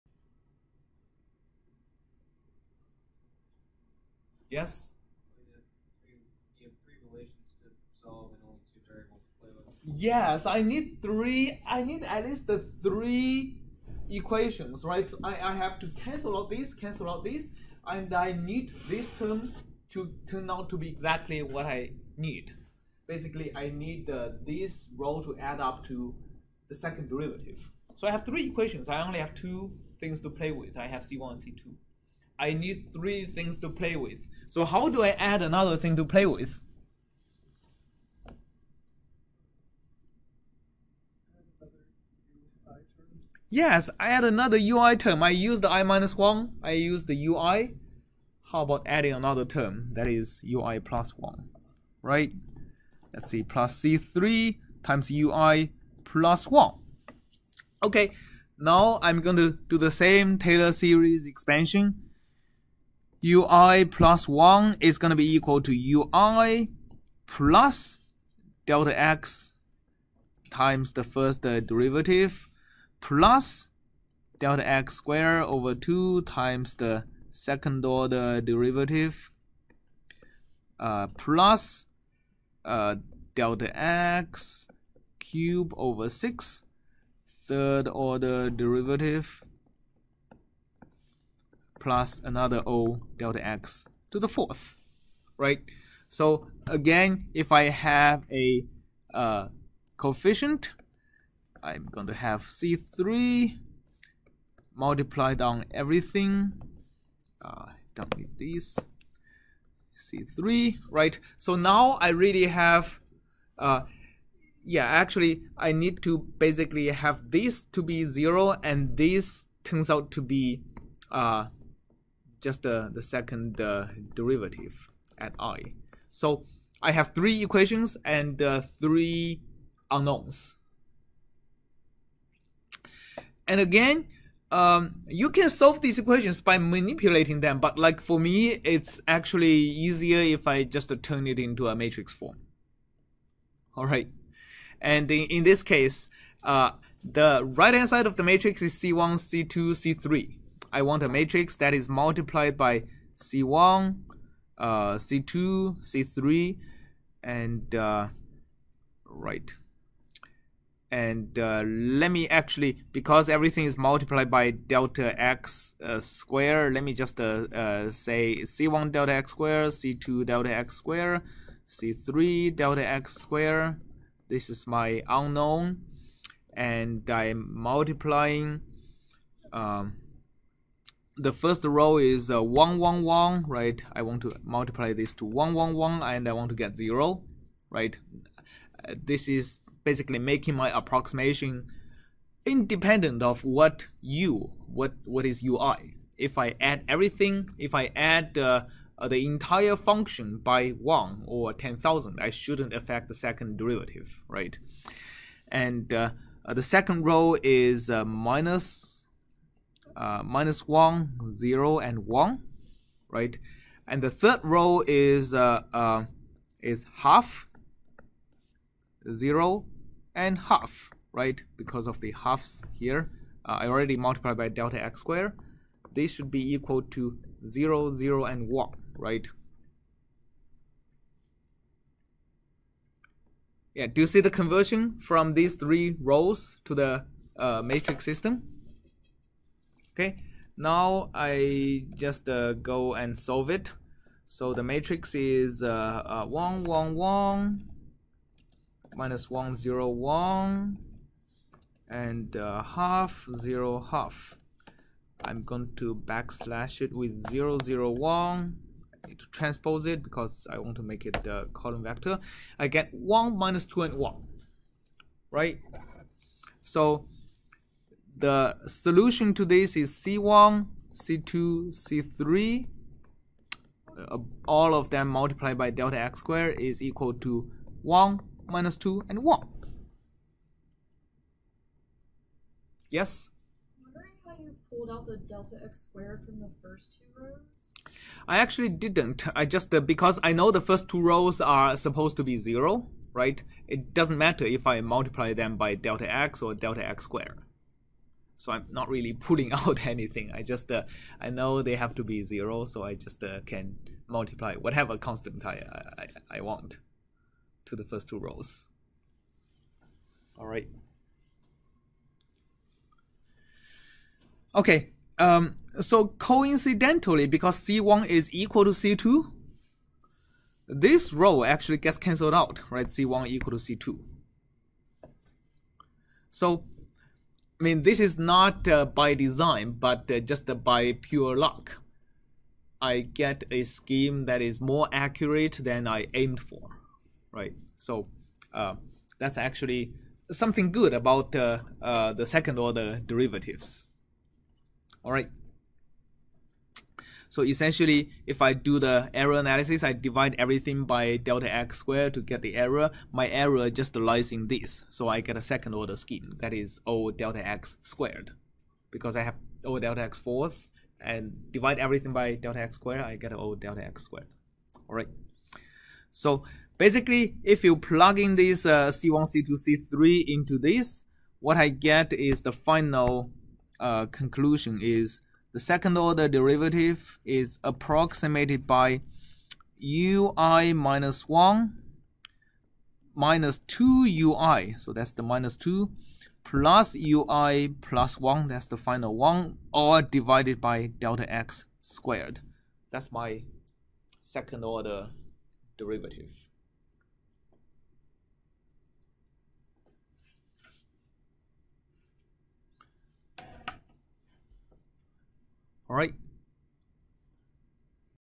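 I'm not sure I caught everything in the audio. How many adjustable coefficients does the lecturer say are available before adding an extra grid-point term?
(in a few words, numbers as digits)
2.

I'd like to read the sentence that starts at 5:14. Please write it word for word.
Okay, um, so coincidentally, because C1 is equal to C2, this row actually gets cancelled out, right?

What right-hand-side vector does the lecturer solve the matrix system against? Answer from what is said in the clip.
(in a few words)
0, 0, 1.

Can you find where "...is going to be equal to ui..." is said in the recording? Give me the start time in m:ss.
1:04.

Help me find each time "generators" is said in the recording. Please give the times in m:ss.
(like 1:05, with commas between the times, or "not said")
not said.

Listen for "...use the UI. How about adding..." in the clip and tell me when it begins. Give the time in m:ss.
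0:46.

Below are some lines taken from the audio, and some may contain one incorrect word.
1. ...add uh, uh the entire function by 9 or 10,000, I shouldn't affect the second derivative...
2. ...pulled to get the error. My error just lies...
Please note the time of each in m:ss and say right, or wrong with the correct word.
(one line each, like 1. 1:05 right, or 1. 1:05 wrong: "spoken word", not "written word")
1. 3:17 wrong: "1", not "9"
2. 5:51 wrong: "squared", not "pulled".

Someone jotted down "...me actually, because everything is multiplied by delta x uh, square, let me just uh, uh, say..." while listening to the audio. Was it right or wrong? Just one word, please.
right.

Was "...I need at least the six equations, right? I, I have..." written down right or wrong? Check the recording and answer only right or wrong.
wrong.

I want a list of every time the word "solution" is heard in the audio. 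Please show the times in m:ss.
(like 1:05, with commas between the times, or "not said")
4:28.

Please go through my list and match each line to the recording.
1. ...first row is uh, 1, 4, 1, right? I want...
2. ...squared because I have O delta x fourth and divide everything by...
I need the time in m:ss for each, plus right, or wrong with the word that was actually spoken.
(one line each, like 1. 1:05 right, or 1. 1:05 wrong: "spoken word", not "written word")
1. 3:01 wrong: "1", not "4"
2. 5:57 right.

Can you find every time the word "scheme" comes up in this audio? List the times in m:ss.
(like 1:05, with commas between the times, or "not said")
5:33, 5:55.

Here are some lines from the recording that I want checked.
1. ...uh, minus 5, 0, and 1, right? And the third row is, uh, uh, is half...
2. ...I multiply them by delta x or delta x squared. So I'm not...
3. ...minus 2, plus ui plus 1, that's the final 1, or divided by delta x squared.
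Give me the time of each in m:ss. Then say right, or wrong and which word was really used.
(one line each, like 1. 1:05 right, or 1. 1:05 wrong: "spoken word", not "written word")
1. 3:29 wrong: "1", not "5"
2. 4:54 right
3. 6:25 right.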